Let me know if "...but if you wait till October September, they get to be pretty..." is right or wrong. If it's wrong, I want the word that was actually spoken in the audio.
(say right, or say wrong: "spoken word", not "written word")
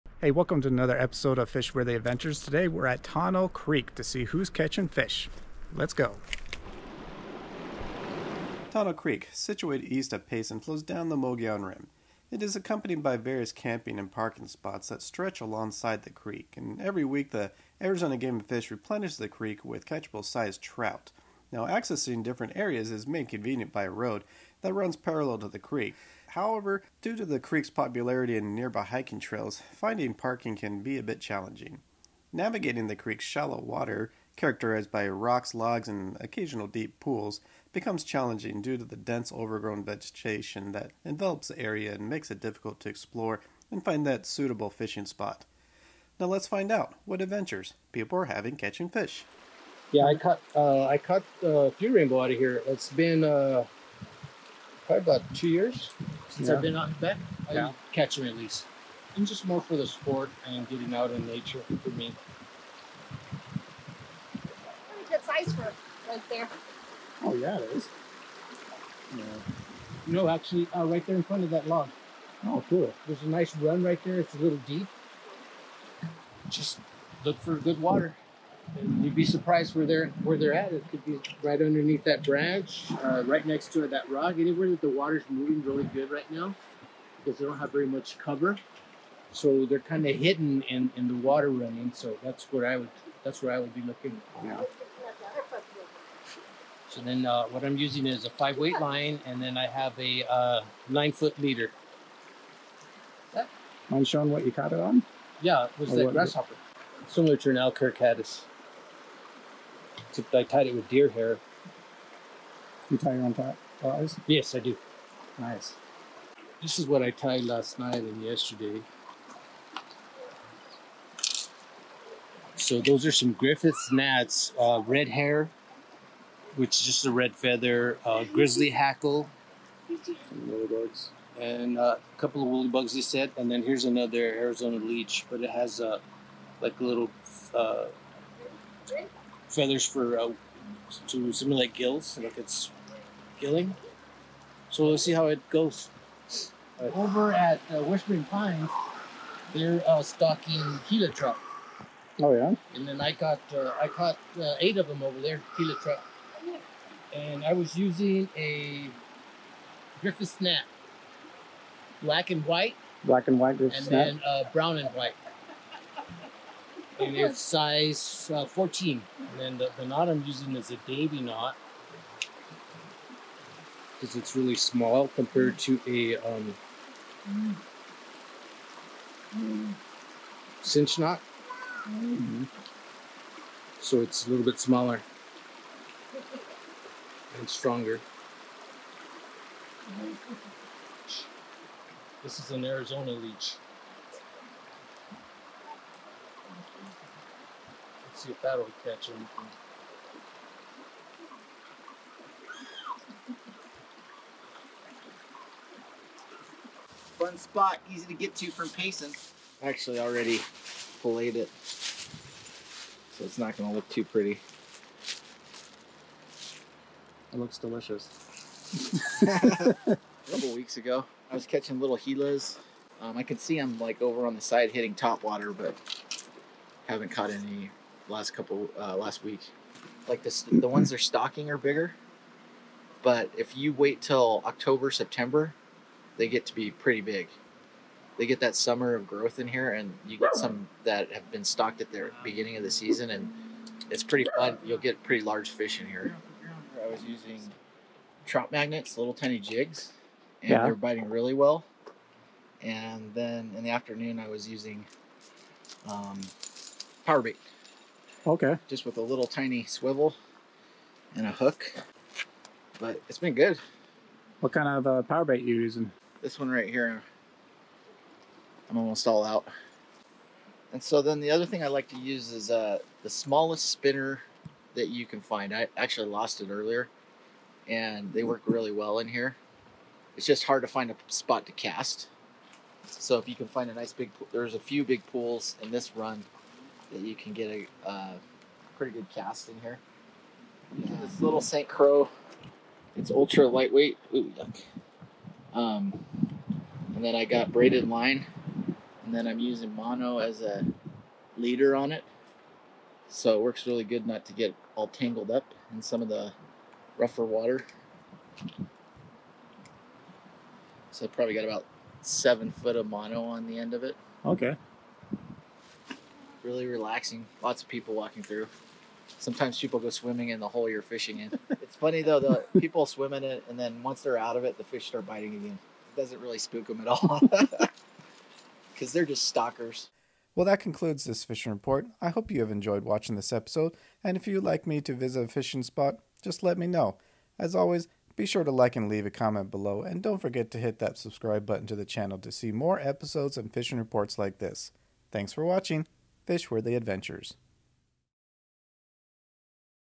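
right.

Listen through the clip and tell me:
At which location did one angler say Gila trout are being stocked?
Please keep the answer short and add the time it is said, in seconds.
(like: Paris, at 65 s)
Whispering Pines, at 147 s.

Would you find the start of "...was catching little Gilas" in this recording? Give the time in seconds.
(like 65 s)
221 s.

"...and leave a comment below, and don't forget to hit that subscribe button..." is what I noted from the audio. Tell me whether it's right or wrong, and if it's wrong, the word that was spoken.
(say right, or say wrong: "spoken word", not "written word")
right.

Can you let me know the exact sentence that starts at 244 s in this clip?
You'll get pretty large fish in here.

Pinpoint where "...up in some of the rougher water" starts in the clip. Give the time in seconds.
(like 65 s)
305 s.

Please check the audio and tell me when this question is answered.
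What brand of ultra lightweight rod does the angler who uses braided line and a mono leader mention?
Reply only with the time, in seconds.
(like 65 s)
291 s.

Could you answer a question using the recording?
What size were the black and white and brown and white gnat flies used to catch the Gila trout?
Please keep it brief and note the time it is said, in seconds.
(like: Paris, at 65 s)
14, at 168 s.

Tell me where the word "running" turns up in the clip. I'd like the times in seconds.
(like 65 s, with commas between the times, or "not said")
91 s.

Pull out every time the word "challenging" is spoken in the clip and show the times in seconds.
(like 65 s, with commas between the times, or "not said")
31 s, 38 s.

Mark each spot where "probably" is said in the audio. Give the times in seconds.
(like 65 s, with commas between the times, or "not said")
54 s, 311 s.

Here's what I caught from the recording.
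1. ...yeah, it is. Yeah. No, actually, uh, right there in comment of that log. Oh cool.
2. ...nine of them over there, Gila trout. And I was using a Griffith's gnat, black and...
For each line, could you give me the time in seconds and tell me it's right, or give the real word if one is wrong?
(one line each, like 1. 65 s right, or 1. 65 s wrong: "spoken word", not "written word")
1. 67 s wrong: "front", not "comment"
2. 154 s wrong: "eight", not "nine".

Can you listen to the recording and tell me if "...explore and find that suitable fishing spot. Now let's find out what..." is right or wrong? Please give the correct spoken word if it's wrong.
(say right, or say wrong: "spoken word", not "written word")
right.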